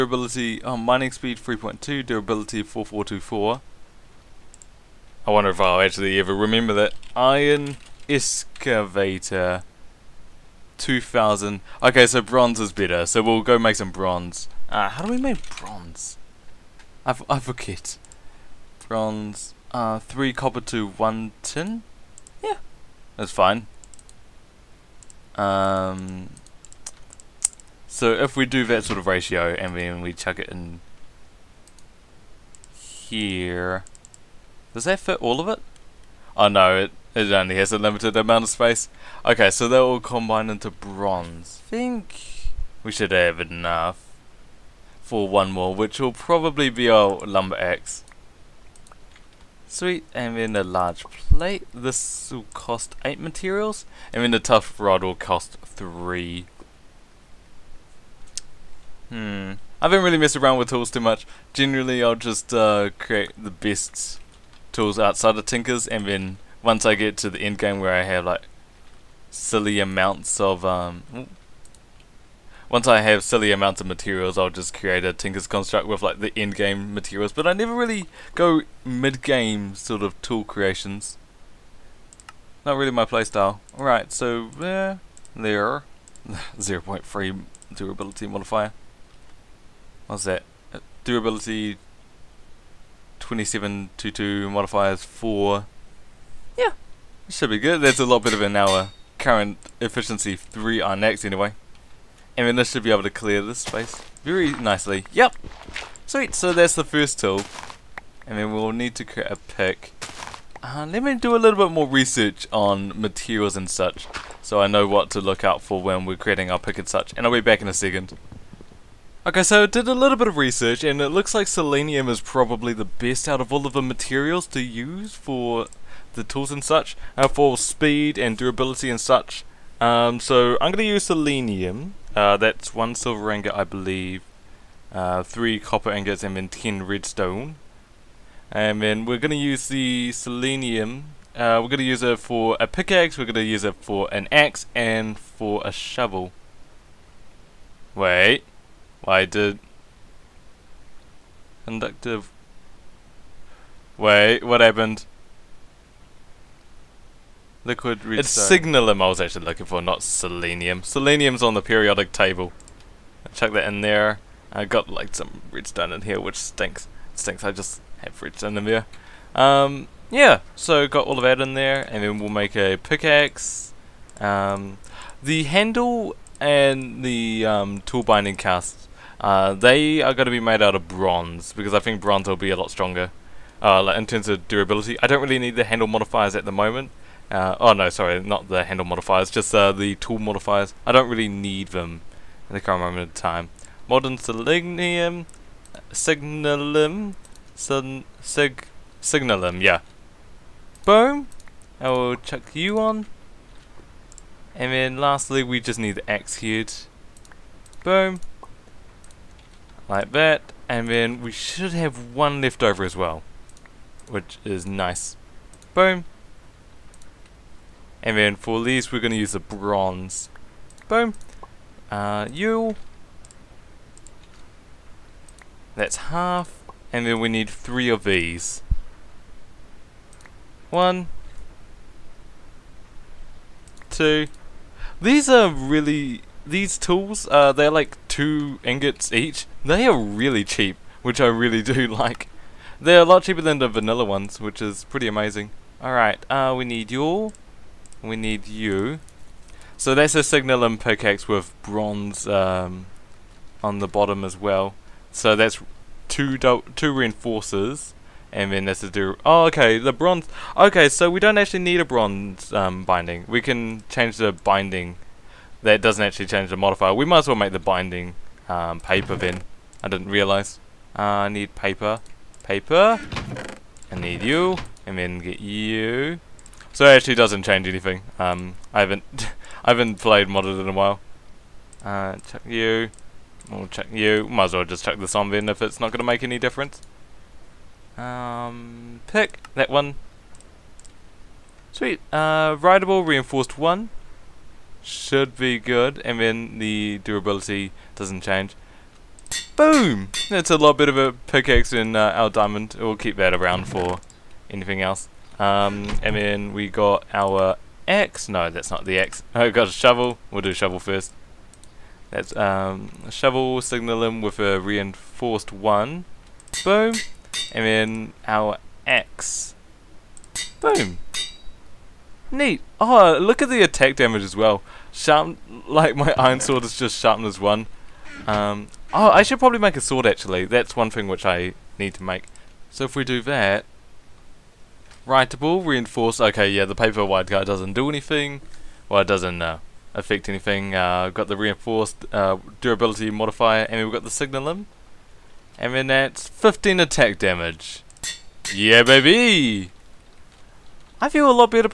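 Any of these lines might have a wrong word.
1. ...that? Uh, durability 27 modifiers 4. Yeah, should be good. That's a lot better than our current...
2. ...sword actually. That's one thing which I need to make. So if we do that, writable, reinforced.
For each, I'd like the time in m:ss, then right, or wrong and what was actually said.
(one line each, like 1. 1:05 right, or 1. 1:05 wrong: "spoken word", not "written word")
1. 1:30 right
2. 5:29 right.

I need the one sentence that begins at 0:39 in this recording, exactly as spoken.
Okay, so they will all into bronze.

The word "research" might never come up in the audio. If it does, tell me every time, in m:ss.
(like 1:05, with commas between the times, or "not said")
1:51, 2:00.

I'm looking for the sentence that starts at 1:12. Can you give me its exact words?
Once I have silly amounts of materials, I'll just create a Tinker's construct with like the end game materials.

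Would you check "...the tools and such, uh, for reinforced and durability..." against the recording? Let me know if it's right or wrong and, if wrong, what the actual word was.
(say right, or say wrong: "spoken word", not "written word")
wrong: "speed", not "reinforced".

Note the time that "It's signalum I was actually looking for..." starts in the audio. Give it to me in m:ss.
2:38.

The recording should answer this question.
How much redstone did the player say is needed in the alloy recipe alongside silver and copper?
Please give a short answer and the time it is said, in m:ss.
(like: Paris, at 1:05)
10 redstone, at 2:16.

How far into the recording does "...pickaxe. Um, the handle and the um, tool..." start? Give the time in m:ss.
2:52.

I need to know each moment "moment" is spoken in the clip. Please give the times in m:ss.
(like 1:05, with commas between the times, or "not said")
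3:06, 3:12.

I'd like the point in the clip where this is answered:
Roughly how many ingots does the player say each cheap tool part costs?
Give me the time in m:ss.
3:58.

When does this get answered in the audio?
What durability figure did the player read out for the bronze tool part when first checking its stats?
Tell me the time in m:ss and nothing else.
0:02.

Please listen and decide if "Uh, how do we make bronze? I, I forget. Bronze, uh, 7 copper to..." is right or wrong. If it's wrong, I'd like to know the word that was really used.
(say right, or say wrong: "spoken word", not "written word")
wrong: "3", not "7".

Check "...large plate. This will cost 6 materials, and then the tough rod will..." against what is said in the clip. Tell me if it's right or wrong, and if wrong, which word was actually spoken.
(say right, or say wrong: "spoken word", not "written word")
wrong: "8", not "6".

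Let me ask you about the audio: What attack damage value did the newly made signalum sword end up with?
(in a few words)
15.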